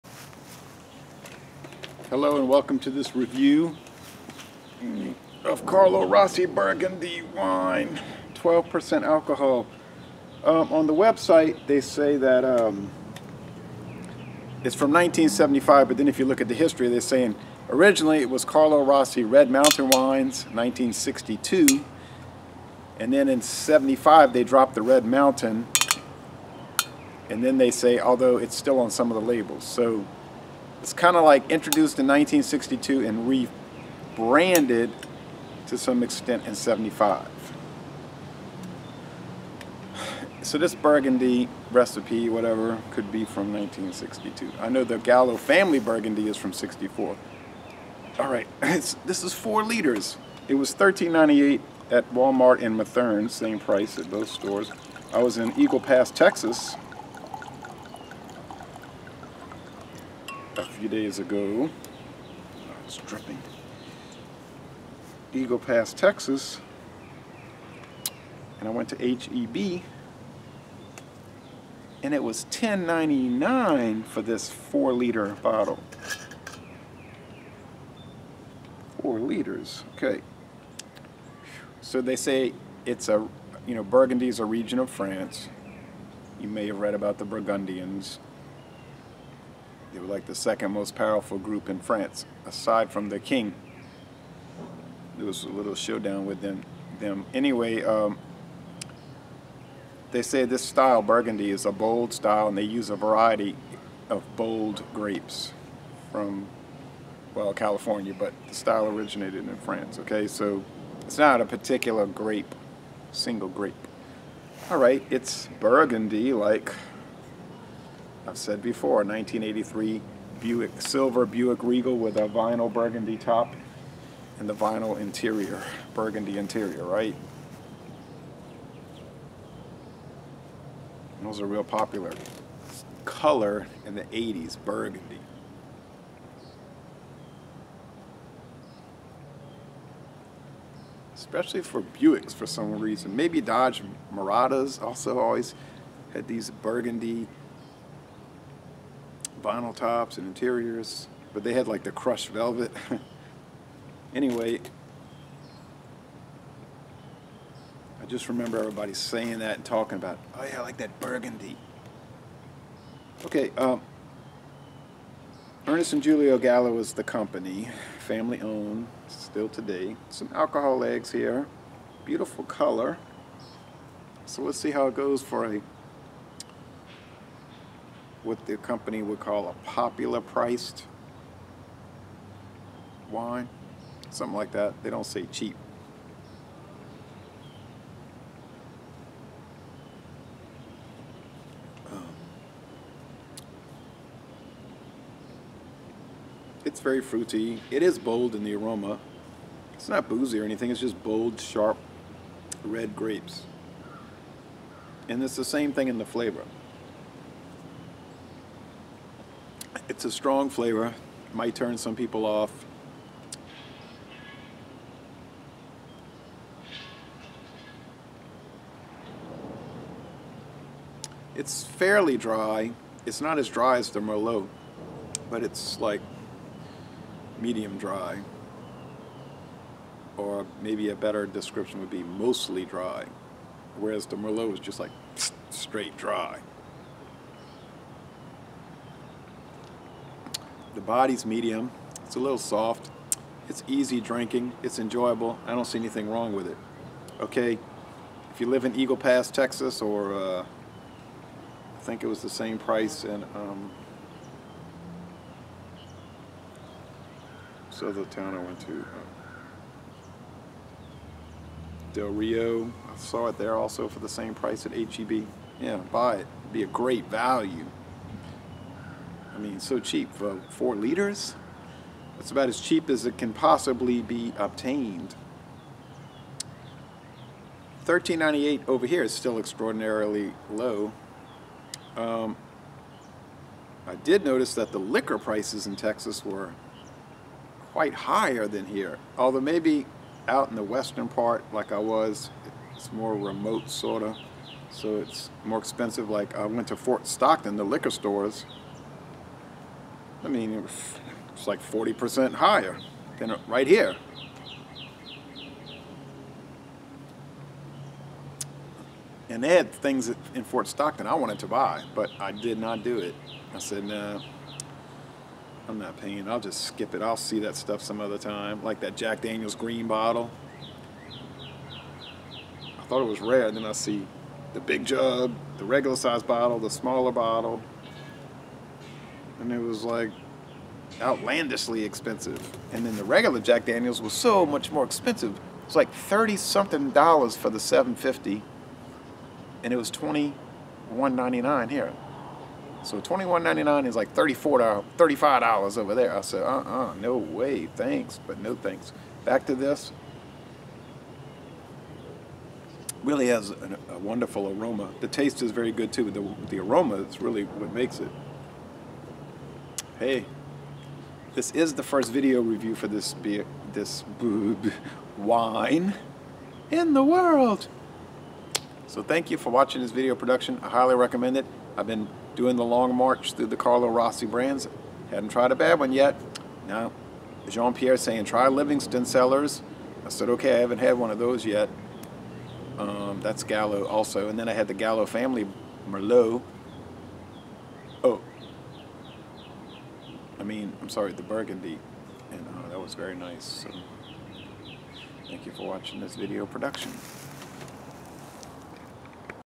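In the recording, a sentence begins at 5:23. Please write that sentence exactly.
Then I see the big jug, the regular size bottle, the smaller bottle, and it was like outlandishly expensive.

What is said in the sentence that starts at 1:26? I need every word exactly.
You may have read about the Burgundians.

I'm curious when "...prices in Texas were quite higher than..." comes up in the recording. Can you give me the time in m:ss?
4:45.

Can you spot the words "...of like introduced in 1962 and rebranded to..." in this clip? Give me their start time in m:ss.
0:31.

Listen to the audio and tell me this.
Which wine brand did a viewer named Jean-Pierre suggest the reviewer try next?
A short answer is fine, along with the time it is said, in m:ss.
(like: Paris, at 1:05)
Livingston Cellars, at 6:18.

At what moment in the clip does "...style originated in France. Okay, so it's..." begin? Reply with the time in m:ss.
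1:48.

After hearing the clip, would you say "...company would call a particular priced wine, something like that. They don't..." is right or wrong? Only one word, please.
wrong.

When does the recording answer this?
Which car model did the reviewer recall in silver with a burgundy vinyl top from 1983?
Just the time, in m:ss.
2:01.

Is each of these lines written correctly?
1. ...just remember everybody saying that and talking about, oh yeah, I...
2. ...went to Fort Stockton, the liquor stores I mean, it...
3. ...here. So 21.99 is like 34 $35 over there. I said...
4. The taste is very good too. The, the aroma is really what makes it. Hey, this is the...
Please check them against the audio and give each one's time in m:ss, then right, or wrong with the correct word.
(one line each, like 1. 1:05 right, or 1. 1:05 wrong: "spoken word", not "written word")
1. 2:38 right
2. 4:56 right
3. 5:41 right
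4. 5:54 right.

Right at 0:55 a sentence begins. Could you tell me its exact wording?
I was in Eagle Pass, Texas, a few days ago.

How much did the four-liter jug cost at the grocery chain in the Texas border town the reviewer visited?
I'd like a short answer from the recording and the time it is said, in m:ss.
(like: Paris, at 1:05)
$10.99, at 1:12.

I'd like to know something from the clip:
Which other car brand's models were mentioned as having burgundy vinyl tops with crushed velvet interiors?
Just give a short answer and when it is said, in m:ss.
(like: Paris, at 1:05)
Dodge Miradas, at 2:23.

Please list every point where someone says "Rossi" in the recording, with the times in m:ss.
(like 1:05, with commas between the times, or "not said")
0:06, 0:18, 6:13.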